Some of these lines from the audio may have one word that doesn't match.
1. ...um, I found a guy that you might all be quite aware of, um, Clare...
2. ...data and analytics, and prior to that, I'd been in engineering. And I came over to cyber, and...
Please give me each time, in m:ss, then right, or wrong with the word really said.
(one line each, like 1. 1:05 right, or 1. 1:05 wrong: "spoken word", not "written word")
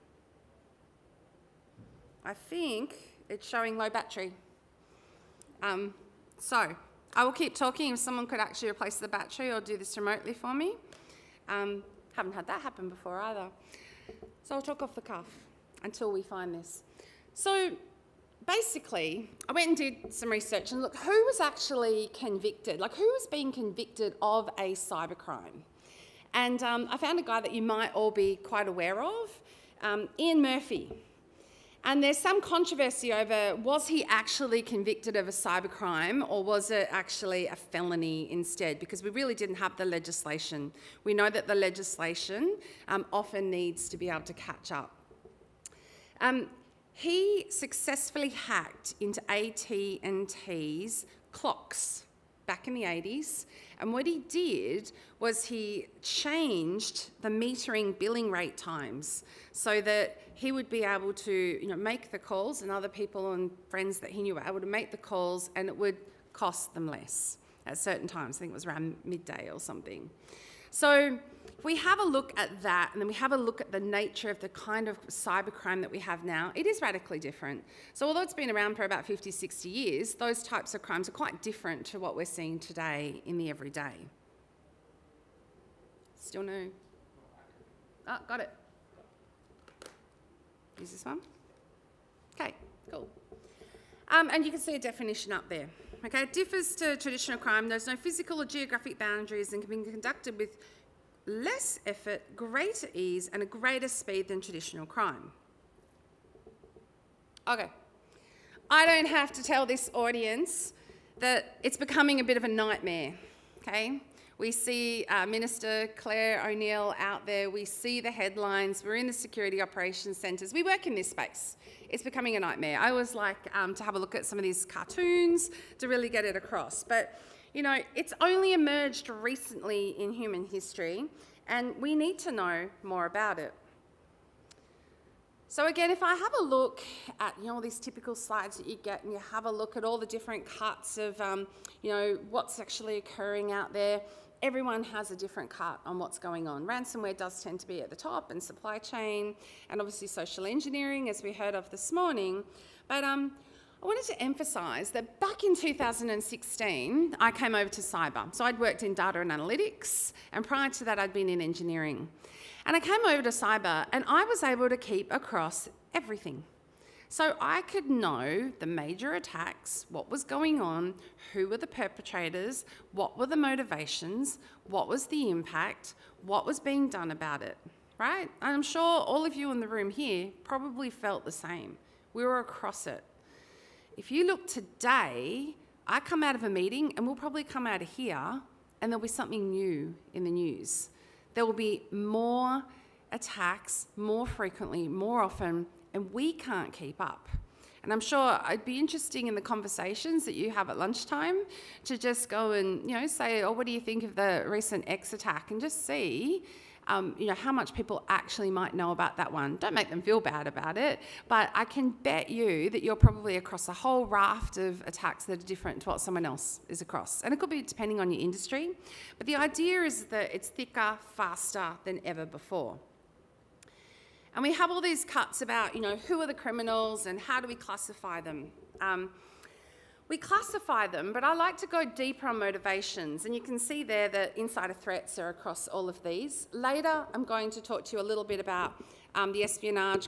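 1. 0:26 wrong: "Ian", not "Clare"
2. 2:38 right.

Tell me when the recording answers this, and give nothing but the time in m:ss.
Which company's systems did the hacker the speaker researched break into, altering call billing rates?
0:49.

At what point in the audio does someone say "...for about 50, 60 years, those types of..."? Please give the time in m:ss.
1:18.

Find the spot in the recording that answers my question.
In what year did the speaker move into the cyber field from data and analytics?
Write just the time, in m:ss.
2:35.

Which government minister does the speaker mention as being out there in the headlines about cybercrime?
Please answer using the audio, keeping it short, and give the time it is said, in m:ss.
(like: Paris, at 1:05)
Clare O'Neil, at 1:55.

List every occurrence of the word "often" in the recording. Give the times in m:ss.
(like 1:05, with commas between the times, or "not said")
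0:43, 3:15.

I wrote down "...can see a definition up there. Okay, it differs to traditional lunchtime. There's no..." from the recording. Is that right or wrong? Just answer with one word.
wrong.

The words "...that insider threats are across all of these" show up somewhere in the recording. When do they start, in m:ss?
3:54.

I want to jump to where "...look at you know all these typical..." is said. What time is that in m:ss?
2:16.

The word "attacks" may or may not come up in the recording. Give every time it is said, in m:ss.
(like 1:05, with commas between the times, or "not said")
2:49, 3:13, 3:25, 3:34.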